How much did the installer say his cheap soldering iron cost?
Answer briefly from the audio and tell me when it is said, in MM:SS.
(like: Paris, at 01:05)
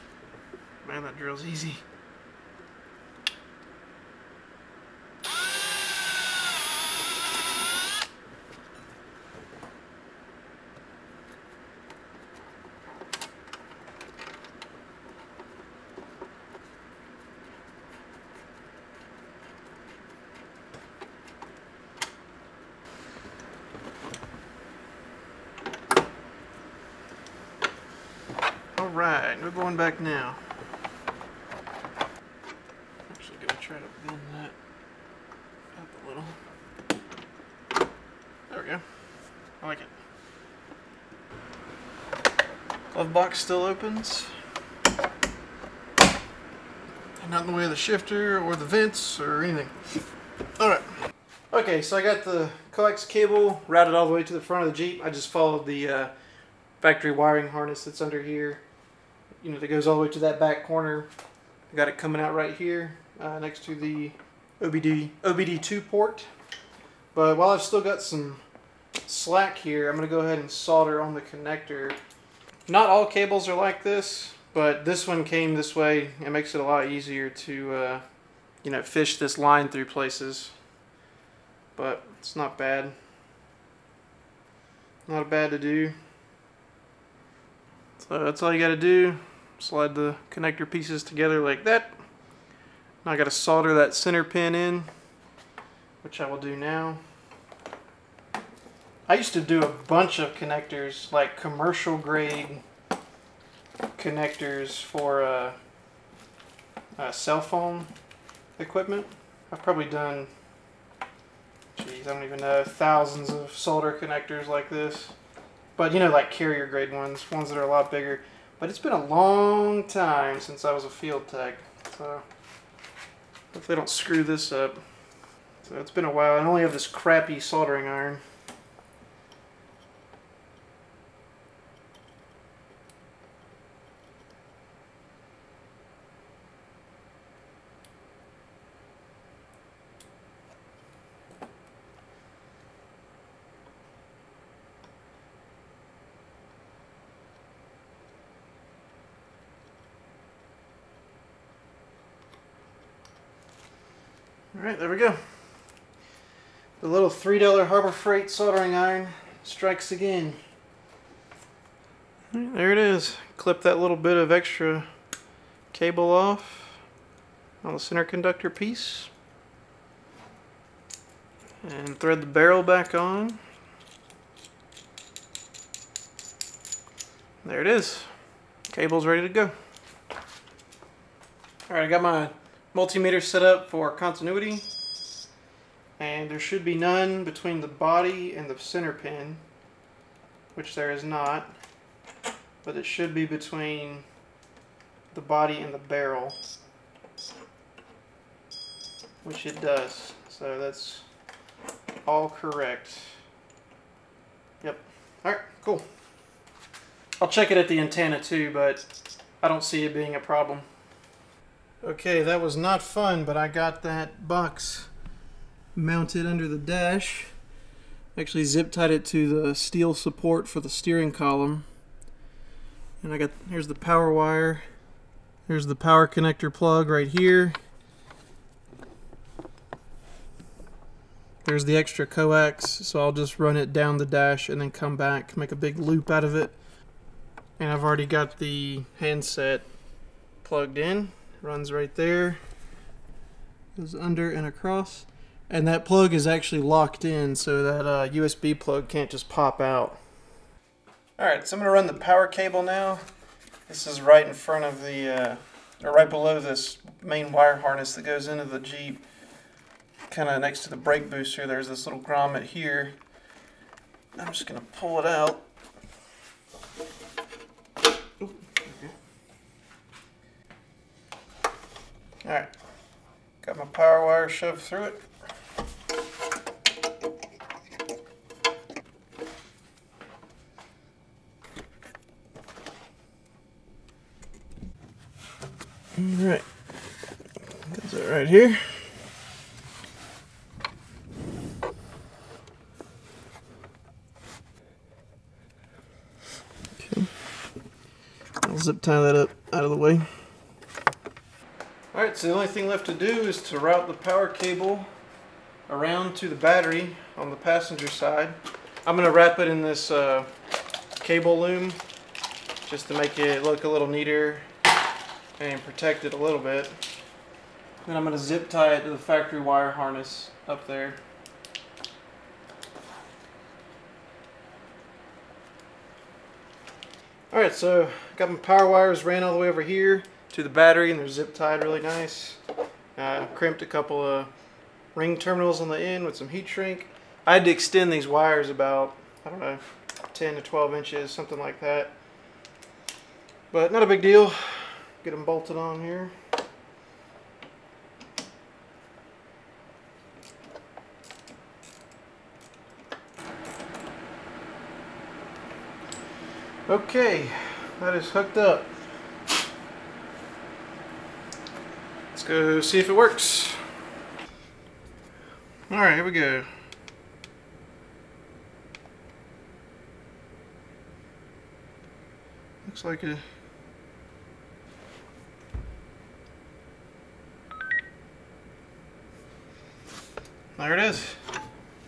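$3, at 02:37.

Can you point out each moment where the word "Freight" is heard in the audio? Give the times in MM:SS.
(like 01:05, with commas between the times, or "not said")
02:37.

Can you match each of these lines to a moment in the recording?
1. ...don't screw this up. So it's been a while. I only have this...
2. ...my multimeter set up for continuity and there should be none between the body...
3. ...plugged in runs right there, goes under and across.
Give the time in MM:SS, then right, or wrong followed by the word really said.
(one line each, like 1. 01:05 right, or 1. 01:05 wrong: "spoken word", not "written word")
1. 02:03 right
2. 03:02 right
3. 04:00 right.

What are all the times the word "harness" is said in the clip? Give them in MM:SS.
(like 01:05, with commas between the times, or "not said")
00:57, 04:17, 05:19.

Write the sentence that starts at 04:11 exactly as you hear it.
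All right, so I'm gonna run the power cable now.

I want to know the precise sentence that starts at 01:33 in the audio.
Now I got to solder that center pin in, which I will do now.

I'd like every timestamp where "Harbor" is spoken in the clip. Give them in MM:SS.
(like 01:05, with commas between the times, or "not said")
02:37.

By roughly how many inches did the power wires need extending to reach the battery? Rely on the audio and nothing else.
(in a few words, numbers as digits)
10 to 12 inches.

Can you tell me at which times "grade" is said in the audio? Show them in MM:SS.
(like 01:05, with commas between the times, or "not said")
01:41, 01:56.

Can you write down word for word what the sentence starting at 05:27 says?
Alright, so got my power wires ran all the way over here to the battery and they're zip tied really nice.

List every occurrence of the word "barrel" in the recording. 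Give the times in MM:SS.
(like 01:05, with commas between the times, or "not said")
02:52, 03:15.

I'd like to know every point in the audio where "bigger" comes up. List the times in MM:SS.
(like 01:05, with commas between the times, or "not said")
01:57.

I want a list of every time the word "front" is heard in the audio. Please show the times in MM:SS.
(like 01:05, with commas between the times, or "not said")
00:54, 04:14.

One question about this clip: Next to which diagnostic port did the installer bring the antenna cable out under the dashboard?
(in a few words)
OBD2 port.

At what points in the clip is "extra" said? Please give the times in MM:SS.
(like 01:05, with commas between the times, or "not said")
02:44, 03:51.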